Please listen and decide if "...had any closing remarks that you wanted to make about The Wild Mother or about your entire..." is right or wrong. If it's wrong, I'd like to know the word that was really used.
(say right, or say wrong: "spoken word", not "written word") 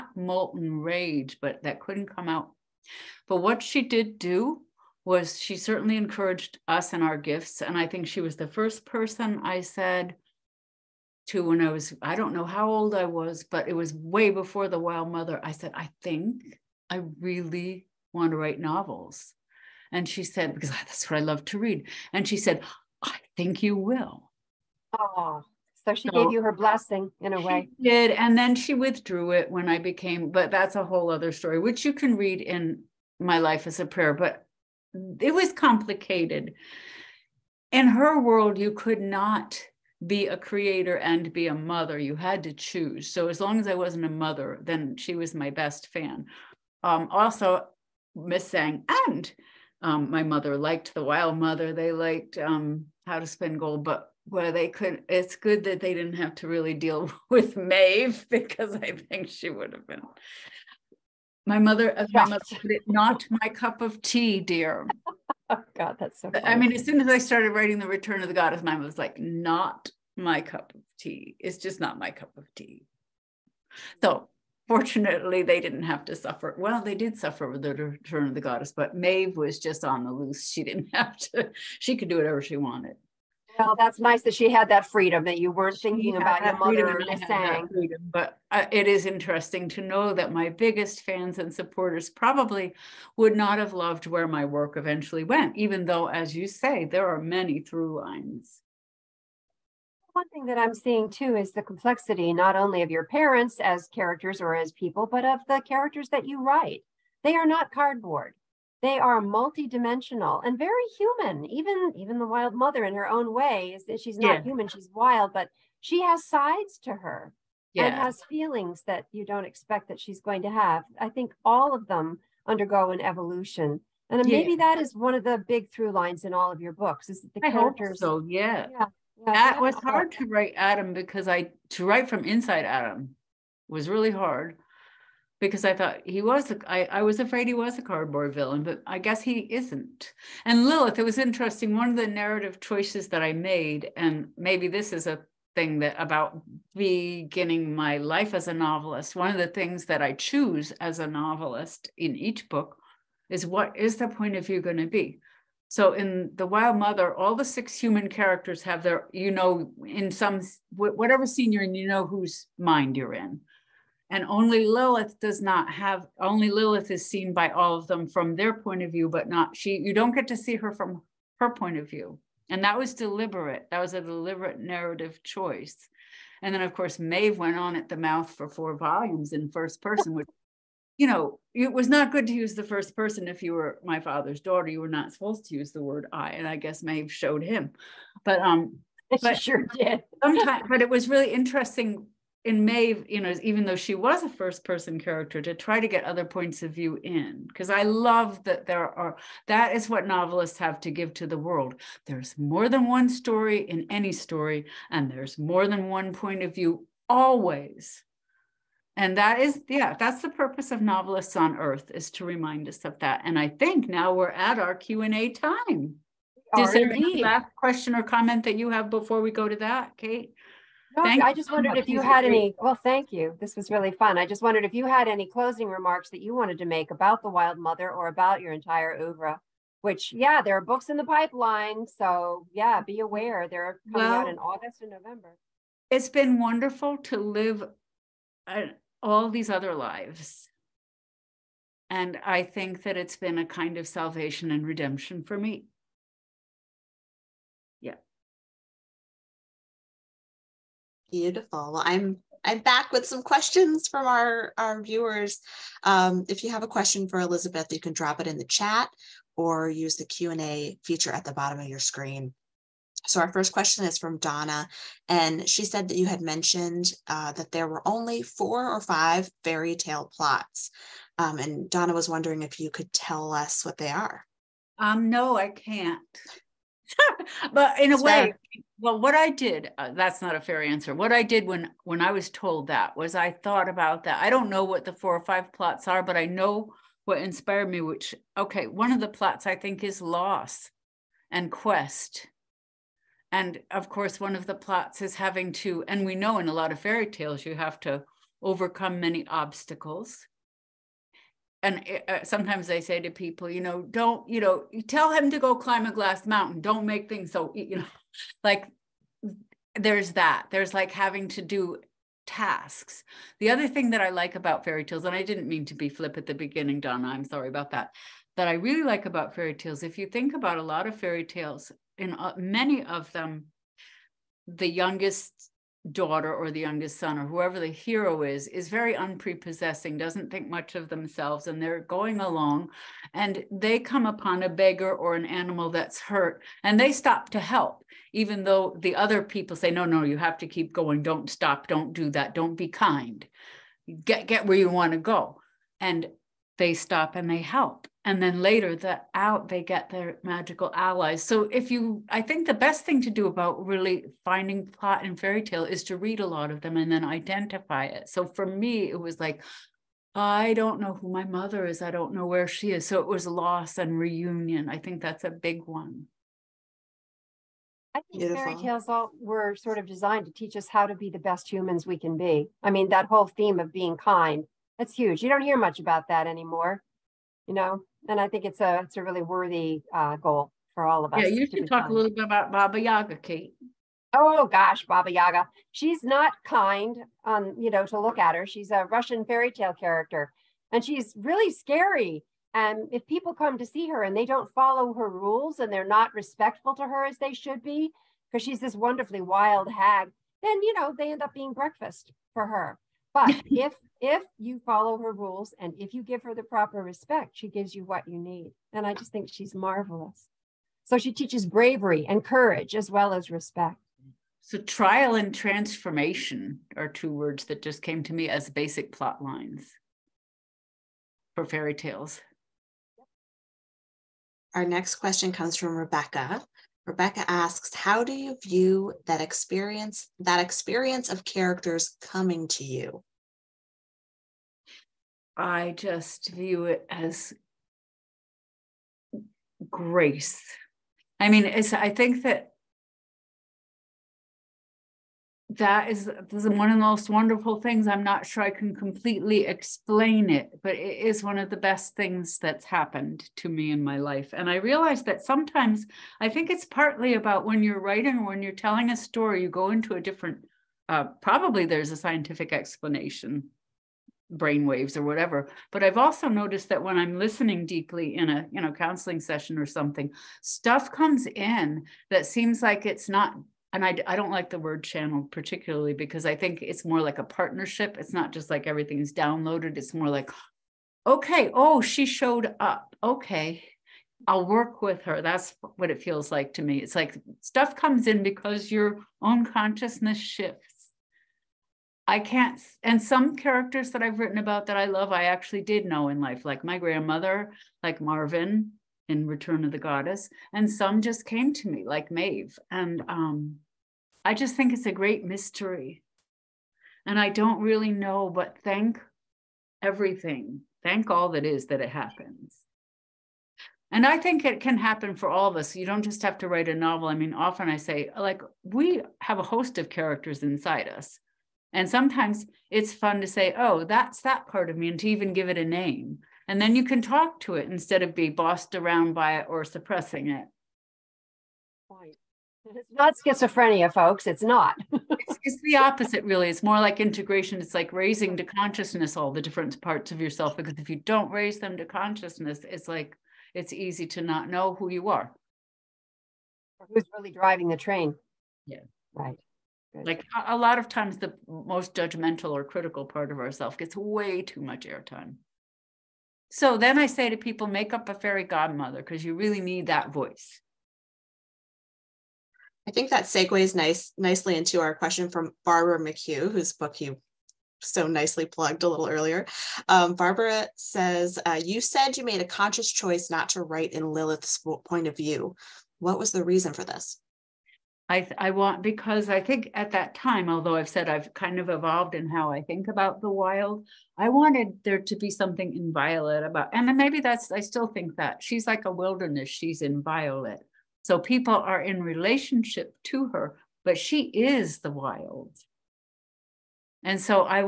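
right.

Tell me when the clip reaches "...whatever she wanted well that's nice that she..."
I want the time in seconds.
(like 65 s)
82 s.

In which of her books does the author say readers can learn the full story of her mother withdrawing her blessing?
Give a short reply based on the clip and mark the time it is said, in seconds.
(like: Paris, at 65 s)
My Life as a Prayer, at 33 s.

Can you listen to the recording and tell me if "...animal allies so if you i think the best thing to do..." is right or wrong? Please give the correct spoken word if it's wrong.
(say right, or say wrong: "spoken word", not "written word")
wrong: "magical", not "animal".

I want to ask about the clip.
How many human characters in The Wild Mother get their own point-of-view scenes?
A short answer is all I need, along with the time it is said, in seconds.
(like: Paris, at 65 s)
6, at 157 s.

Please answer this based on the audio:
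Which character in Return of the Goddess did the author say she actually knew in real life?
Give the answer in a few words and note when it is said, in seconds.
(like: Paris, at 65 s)
Marvin, at 498 s.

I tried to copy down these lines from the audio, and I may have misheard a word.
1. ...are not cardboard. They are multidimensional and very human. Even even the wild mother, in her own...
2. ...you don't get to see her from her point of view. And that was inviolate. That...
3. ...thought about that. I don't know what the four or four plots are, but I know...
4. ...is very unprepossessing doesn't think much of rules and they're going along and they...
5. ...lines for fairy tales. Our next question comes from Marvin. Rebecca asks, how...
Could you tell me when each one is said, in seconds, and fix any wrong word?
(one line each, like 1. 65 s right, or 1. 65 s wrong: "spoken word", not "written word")
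1. 107 s right
2. 169 s wrong: "deliberate", not "inviolate"
3. 283 s wrong: "five", not "four"
4. 328 s wrong: "themselves", not "rules"
5. 419 s wrong: "Rebecca", not "Marvin".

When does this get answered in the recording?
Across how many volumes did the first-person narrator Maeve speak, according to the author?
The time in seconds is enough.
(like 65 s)
178 s.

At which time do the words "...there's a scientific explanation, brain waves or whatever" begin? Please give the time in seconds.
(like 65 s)
461 s.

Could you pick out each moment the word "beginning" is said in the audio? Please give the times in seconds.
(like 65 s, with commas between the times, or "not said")
146 s, 316 s.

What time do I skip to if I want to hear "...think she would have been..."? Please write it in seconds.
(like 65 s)
58 s.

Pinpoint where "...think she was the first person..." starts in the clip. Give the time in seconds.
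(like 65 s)
7 s.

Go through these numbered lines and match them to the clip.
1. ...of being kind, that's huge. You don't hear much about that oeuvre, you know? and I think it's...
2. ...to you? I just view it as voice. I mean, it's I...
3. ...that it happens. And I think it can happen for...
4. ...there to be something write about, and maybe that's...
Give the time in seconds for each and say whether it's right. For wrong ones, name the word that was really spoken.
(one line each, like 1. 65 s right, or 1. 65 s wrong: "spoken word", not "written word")
1. 373 s wrong: "anymore", not "oeuvre"
2. 432 s wrong: "grace", not "voice"
3. 511 s right
4. 584 s wrong: "inviolate", not "write".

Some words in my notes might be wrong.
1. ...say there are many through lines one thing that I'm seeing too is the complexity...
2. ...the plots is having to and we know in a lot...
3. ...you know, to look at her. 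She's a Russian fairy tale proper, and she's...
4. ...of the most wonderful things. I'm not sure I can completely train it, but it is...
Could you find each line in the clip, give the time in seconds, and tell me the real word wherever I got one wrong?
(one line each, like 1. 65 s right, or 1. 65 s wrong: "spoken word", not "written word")
1. 96 s right
2. 294 s right
3. 387 s wrong: "character", not "proper"
4. 446 s wrong: "explain", not "train".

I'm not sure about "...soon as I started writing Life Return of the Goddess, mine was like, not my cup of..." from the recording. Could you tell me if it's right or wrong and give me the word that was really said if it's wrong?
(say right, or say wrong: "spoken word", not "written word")
wrong: "The", not "Life".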